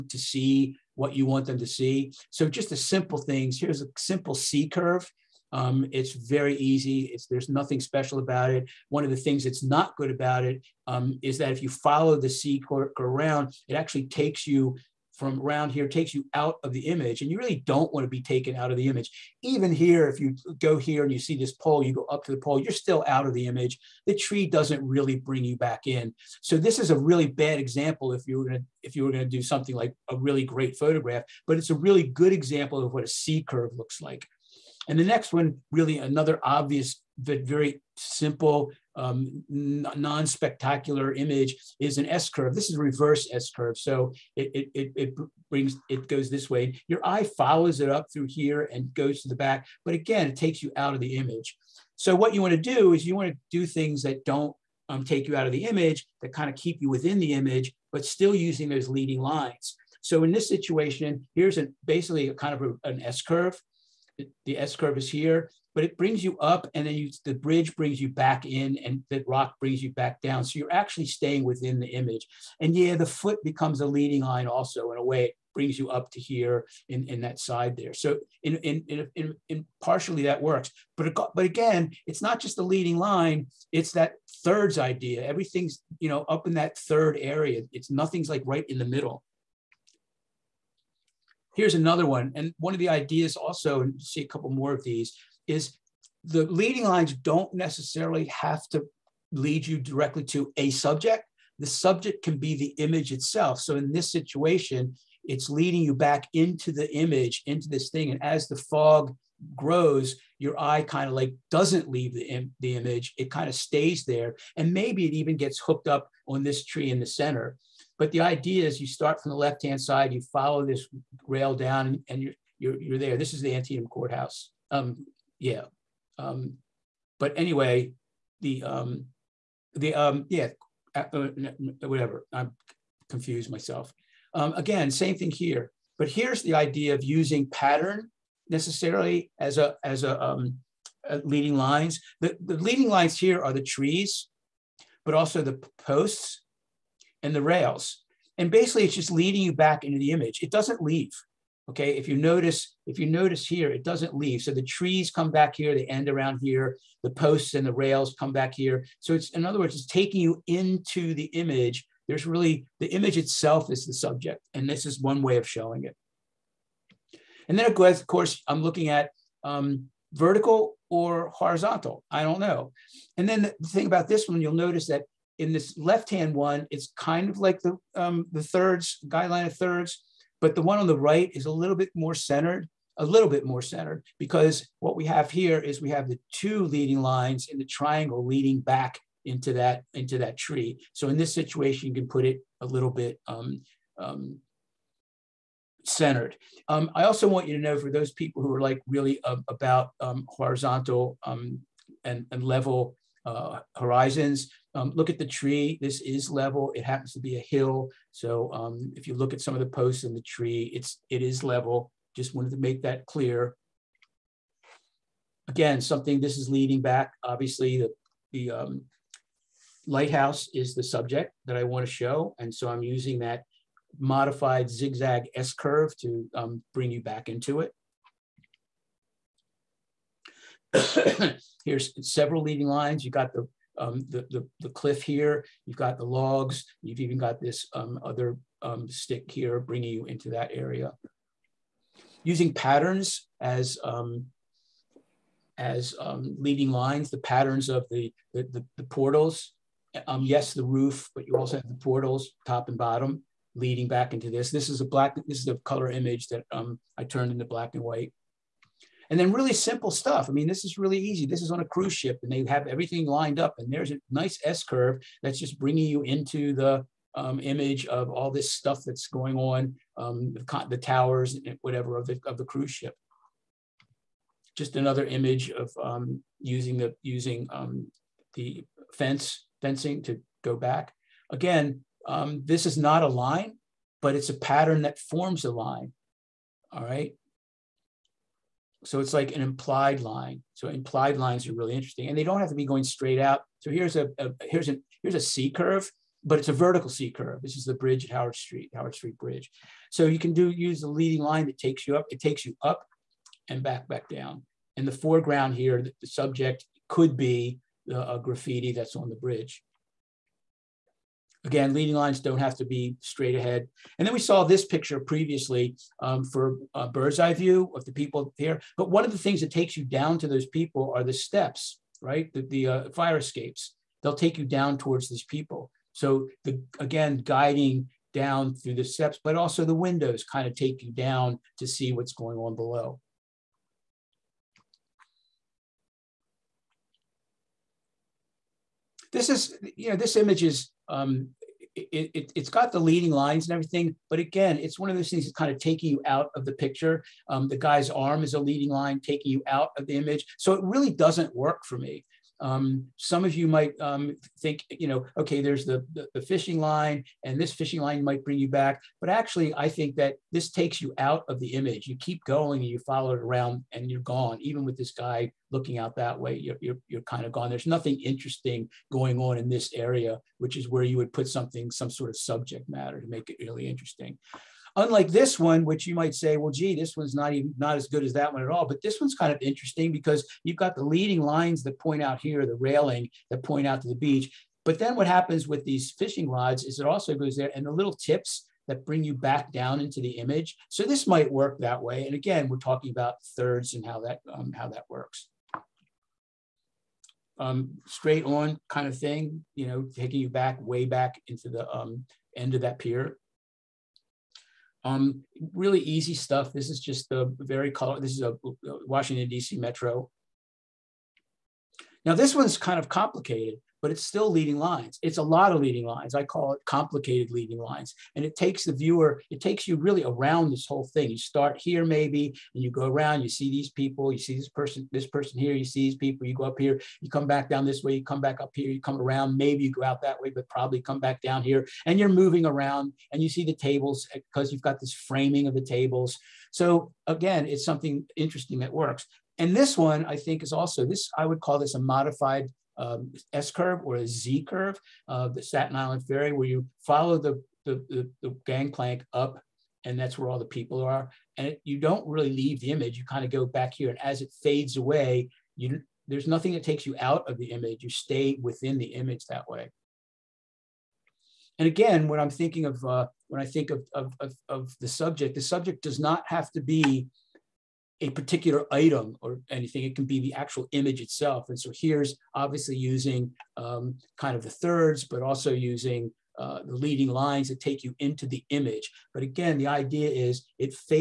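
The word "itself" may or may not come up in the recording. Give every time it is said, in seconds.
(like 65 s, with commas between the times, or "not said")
103 s, 163 s, 470 s.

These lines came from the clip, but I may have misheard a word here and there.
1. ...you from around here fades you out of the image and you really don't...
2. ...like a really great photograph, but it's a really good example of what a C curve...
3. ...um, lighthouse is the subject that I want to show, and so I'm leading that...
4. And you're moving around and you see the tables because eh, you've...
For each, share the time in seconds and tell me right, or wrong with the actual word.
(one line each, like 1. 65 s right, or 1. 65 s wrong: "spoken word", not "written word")
1. 14 s wrong: "takes", not "fades"
2. 29 s right
3. 218 s wrong: "using", not "leading"
4. 431 s right.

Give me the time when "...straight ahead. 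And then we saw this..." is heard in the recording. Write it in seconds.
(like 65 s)
312 s.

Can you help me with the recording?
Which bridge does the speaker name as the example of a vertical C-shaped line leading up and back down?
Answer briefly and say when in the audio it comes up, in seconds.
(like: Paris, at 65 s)
Howard Street Bridge, at 298 s.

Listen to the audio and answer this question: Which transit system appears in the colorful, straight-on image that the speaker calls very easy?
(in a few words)
Washington DC Metro.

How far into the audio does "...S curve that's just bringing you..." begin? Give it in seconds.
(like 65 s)
264 s.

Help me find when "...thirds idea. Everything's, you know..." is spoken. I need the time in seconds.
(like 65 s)
84 s.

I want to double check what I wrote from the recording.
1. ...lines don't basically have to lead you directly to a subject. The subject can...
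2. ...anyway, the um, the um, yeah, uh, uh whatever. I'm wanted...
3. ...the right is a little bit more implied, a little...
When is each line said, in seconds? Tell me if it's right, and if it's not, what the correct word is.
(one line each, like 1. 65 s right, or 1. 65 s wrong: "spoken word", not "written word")
1. 96 s wrong: "necessarily", not "basically"
2. 127 s wrong: "confused", not "wanted"
3. 180 s wrong: "centered", not "implied".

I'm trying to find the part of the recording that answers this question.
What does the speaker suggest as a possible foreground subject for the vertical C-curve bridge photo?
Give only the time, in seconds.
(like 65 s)
308 s.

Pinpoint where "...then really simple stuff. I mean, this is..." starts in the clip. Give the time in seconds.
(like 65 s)
259 s.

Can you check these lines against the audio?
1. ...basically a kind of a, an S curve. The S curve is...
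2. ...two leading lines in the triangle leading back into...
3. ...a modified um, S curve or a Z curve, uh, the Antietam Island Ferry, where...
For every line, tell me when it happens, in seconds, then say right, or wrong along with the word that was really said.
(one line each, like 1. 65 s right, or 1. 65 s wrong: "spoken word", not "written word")
1. 61 s right
2. 186 s right
3. 441 s wrong: "Staten", not "Antietam".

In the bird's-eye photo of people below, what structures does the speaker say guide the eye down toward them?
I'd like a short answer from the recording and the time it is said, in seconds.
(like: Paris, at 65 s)
Fire escapes, at 322 s.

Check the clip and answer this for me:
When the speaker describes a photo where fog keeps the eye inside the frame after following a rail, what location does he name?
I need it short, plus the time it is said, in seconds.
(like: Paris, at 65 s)
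Antietam Courthouse, at 123 s.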